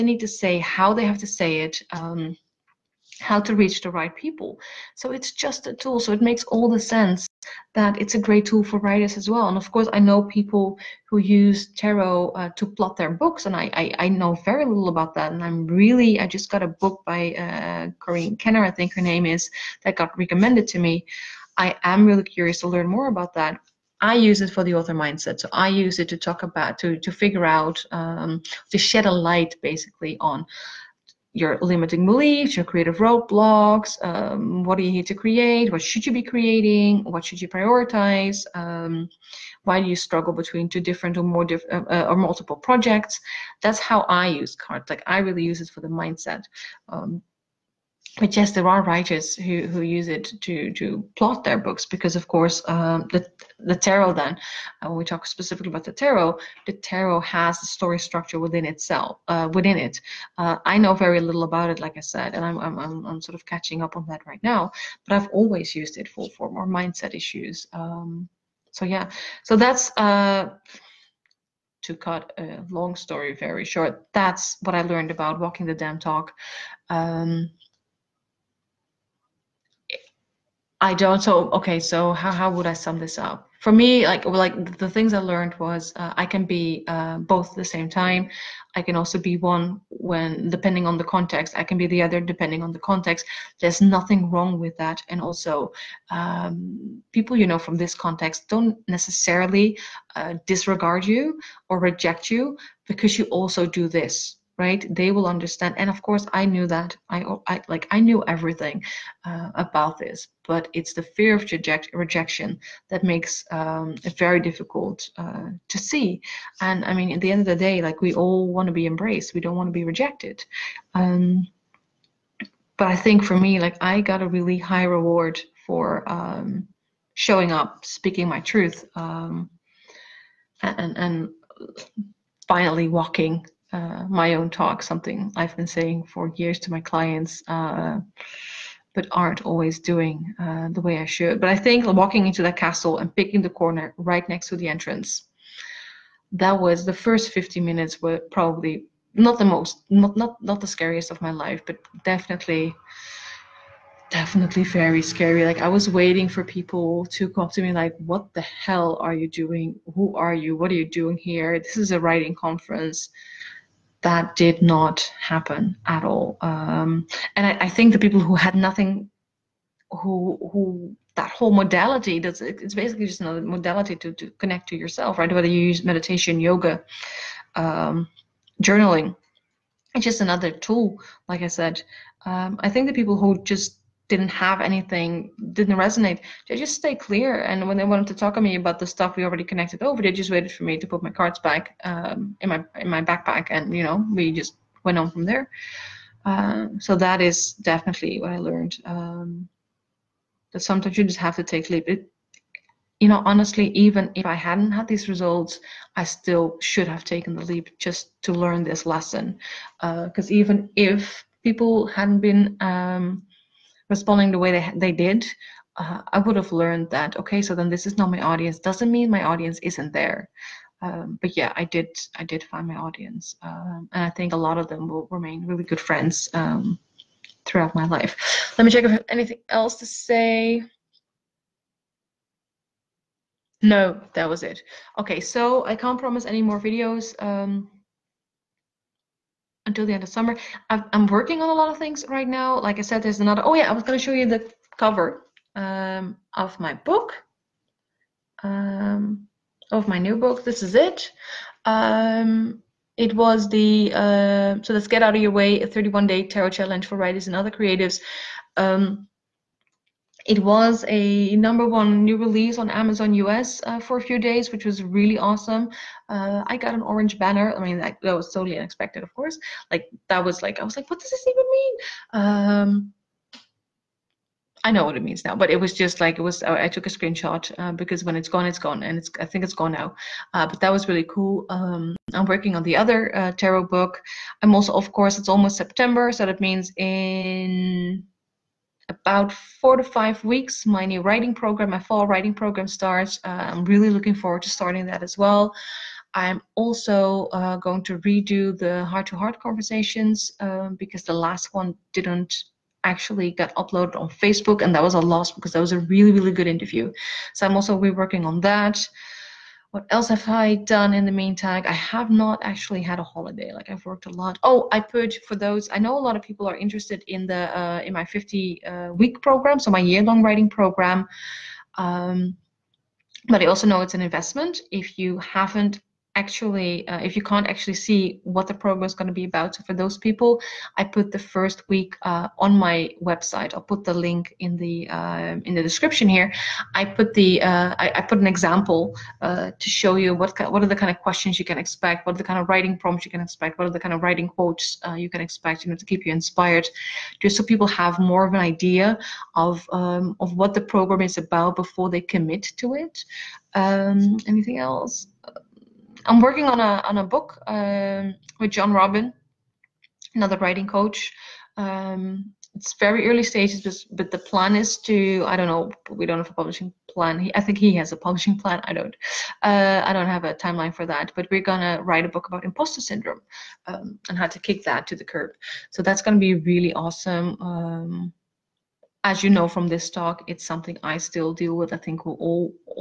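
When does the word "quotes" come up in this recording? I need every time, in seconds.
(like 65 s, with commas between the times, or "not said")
344 s.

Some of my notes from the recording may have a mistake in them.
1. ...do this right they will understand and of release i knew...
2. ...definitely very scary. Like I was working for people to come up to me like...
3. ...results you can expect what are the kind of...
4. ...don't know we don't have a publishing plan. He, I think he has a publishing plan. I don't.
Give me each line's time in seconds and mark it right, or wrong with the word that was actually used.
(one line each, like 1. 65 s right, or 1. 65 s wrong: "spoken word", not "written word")
1. 103 s wrong: "course", not "release"
2. 154 s wrong: "waiting", not "working"
3. 342 s wrong: "prompts", not "results"
4. 365 s right.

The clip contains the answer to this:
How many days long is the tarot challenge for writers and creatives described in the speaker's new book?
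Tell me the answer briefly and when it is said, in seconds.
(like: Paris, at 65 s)
31, at 255 s.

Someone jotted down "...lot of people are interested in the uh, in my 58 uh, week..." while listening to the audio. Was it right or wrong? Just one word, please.
wrong.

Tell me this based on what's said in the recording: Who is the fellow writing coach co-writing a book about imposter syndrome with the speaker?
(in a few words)
John Robin.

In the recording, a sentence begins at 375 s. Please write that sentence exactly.
So that's gonna be really awesome um, as you know from this talk, it's something I still deal with.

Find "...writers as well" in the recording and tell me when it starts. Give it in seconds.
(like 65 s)
8 s.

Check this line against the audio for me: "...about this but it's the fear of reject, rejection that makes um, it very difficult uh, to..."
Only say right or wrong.
right.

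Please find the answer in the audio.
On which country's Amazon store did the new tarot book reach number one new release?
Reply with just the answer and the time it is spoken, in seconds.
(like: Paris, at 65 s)
US, at 262 s.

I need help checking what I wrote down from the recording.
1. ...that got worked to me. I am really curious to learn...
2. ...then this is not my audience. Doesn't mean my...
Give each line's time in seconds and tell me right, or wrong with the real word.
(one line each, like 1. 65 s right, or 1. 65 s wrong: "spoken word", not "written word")
1. 19 s wrong: "recommended", not "worked"
2. 217 s right.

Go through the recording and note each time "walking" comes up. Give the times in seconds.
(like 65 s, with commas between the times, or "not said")
75 s, 132 s, 141 s.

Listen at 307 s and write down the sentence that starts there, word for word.
So I'm also reworking on that what else have I done in the meantime?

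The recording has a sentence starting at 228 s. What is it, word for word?
Let me check if I have anything else to say.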